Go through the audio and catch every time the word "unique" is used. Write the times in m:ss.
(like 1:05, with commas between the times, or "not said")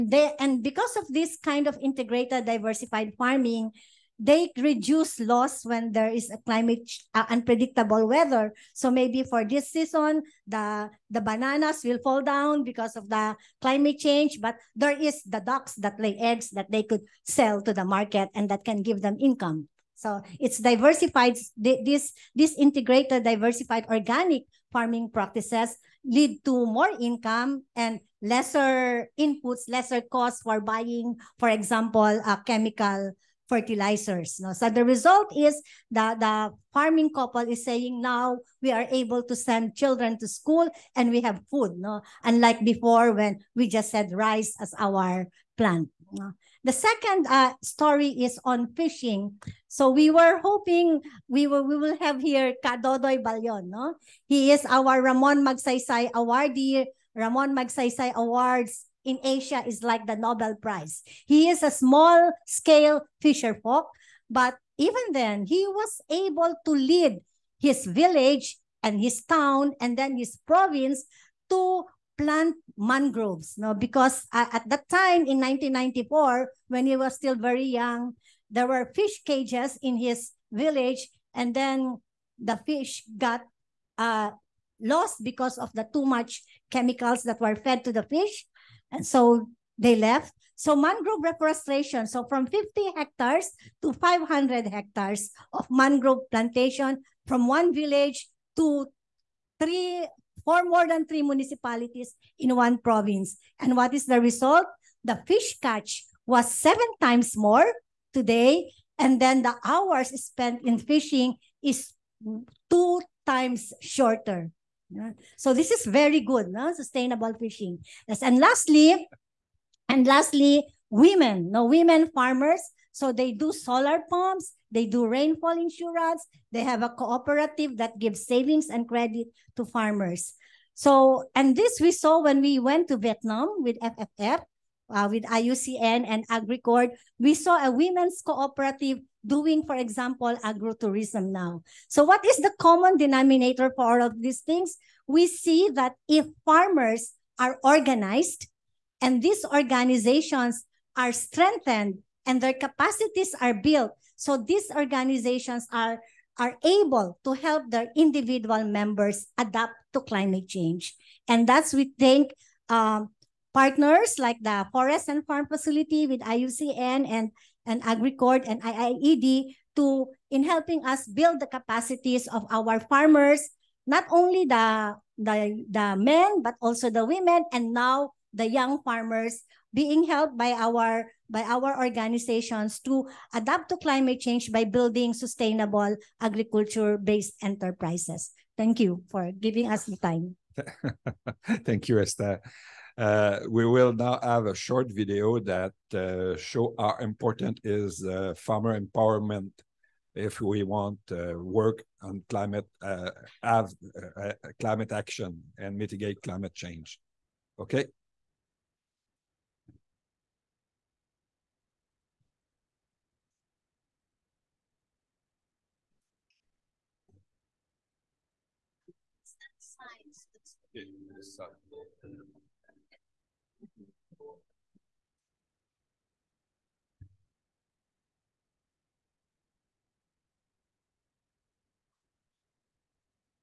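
not said.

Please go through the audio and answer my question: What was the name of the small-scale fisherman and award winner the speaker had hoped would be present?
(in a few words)
Ka Dodoy Ballon.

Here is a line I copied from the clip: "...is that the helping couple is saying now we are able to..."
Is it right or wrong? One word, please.
wrong.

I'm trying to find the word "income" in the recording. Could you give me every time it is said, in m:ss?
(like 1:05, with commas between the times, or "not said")
0:19, 0:26.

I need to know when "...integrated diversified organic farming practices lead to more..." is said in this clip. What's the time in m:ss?
0:22.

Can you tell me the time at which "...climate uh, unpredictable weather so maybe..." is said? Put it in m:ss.
0:06.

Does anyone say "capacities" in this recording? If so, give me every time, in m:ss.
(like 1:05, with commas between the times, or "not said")
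2:32, 2:51.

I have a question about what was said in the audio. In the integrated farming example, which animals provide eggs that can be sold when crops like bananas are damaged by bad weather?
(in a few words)
ducks.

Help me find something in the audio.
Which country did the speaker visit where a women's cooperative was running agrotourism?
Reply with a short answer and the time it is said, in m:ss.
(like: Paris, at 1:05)
Vietnam, at 2:12.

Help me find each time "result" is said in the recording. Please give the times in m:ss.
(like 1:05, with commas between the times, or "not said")
0:34, 1:44.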